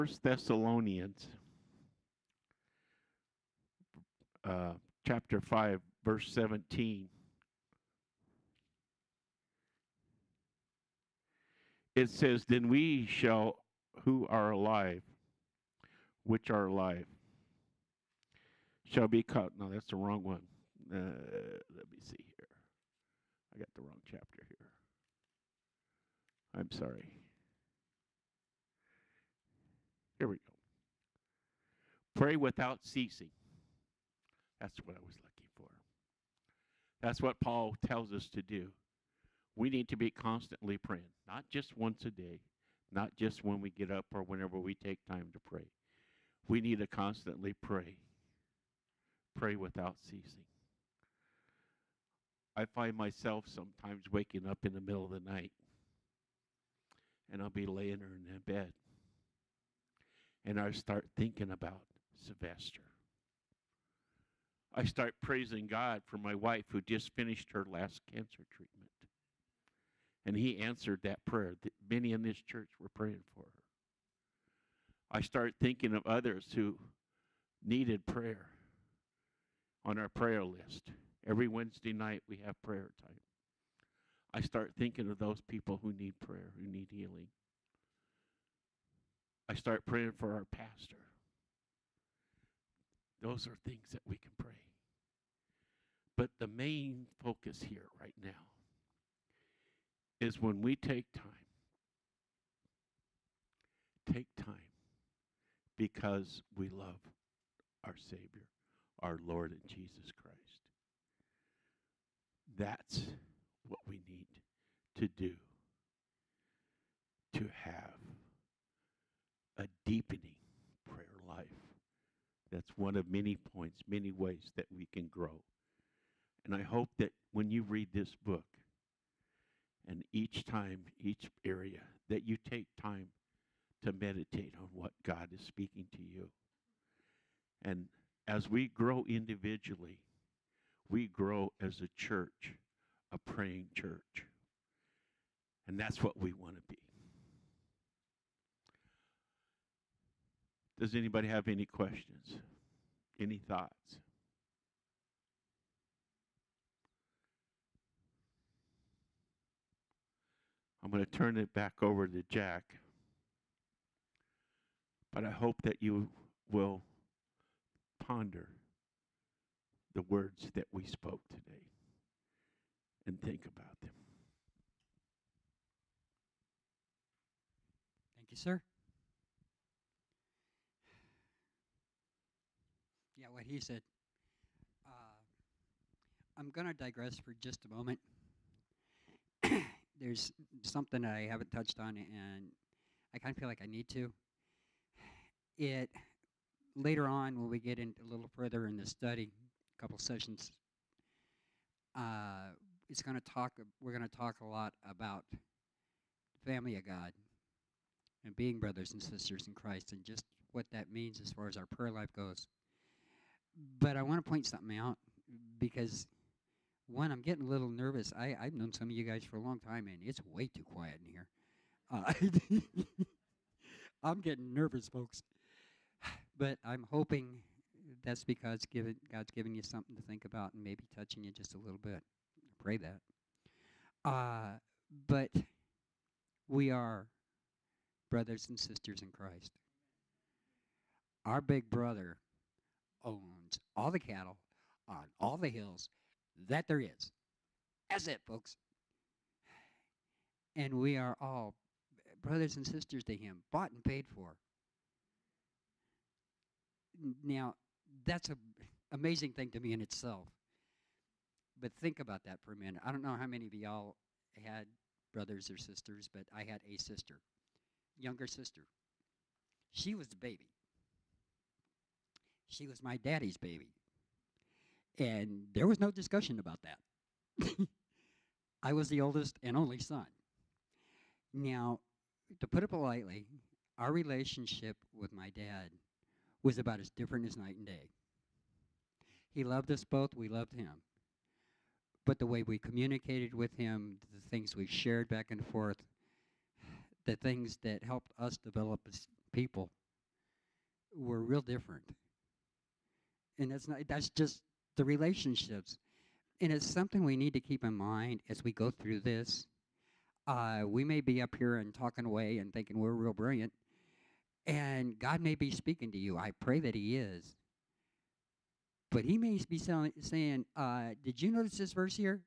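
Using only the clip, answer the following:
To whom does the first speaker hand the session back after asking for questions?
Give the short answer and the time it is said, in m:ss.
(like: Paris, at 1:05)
Jack, at 2:42.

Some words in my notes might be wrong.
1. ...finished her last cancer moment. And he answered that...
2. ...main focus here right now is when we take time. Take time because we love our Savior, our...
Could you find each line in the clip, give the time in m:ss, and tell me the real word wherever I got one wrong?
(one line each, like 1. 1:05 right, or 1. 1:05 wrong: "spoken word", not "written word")
1. 1:07 wrong: "treatment", not "moment"
2. 1:36 right.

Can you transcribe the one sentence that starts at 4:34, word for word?
And there was no discussion about that.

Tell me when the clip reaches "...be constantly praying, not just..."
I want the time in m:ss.
0:39.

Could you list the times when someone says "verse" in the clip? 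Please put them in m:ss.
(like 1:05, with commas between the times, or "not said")
0:06, 5:21.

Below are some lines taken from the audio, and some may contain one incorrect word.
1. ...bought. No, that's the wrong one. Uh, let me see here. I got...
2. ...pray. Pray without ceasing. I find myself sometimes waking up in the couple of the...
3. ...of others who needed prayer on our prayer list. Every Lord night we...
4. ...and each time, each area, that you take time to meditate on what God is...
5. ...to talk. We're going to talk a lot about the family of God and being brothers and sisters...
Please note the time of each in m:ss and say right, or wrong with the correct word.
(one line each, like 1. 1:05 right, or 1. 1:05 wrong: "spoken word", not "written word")
1. 0:19 wrong: "caught", not "bought"
2. 0:47 wrong: "middle", not "couple"
3. 1:15 wrong: "Wednesday", not "Lord"
4. 2:09 right
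5. 3:23 right.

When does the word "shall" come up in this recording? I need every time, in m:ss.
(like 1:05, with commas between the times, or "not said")
0:13, 0:18.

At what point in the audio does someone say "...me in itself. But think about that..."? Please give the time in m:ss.
4:19.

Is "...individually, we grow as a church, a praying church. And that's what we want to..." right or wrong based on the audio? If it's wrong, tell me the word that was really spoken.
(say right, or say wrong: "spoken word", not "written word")
right.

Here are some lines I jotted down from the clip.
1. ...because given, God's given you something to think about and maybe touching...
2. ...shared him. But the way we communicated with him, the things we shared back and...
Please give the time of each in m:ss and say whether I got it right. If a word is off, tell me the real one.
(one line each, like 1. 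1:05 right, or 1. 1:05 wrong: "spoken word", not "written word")
1. 3:48 right
2. 4:50 wrong: "loved", not "shared".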